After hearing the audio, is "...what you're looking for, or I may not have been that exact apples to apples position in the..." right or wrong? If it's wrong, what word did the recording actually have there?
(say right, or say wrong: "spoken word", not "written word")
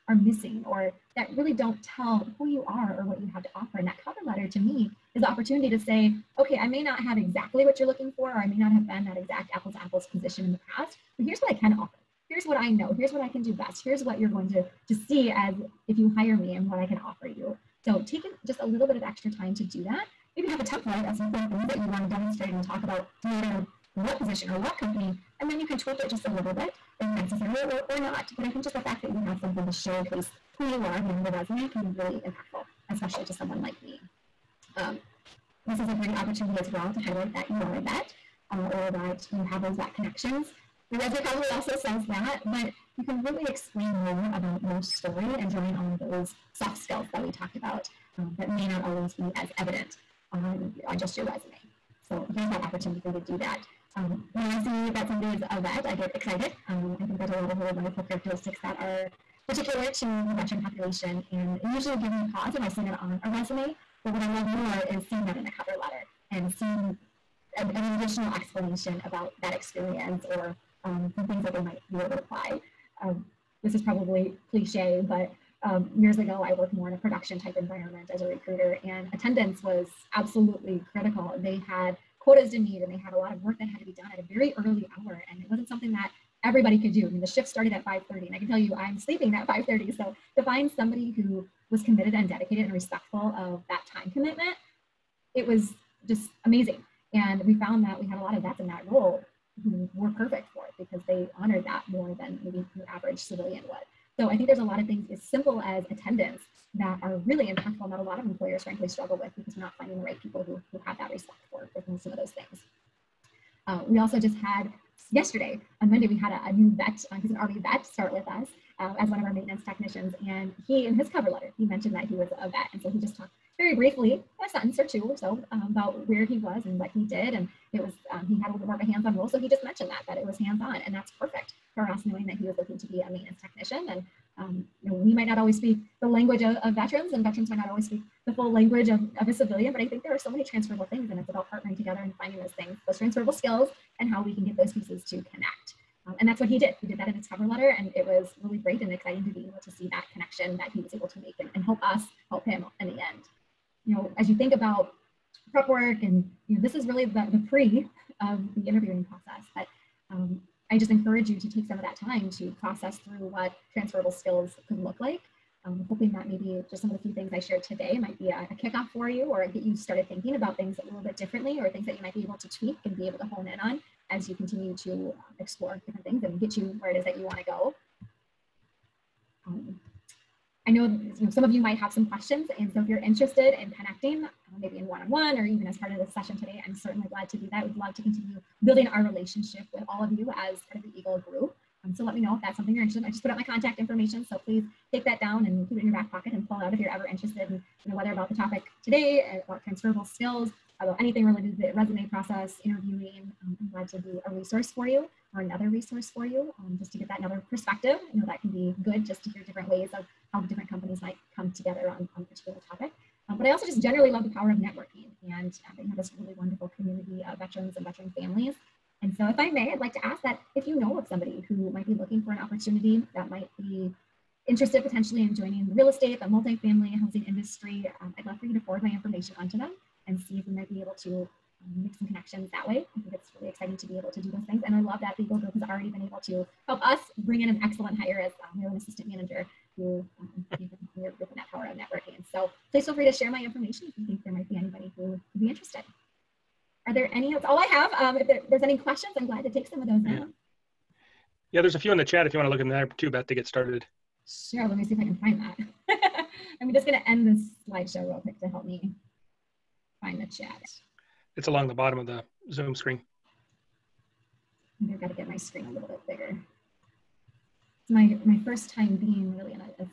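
right.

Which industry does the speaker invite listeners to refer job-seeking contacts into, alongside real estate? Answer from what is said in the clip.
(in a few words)
multifamily housing.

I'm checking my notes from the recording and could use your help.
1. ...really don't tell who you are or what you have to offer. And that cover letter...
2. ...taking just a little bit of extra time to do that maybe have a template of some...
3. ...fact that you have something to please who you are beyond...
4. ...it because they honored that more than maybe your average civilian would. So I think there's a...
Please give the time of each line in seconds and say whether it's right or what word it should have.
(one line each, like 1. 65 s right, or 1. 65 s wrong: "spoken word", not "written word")
1. 1 s right
2. 18 s right
3. 28 s wrong: "showcase", not "please"
4. 100 s right.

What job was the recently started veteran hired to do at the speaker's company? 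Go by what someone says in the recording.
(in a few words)
maintenance technician.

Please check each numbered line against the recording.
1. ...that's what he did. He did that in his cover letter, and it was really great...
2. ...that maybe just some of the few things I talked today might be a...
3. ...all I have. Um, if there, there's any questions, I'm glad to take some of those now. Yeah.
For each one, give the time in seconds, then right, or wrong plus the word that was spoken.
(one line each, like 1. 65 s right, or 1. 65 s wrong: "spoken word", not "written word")
1. 146 s right
2. 166 s wrong: "shared", not "talked"
3. 247 s right.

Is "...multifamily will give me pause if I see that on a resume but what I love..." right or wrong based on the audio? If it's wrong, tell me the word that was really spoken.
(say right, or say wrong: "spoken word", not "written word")
wrong: "usually", not "multifamily".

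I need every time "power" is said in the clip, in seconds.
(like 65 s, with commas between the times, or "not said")
214 s, 241 s.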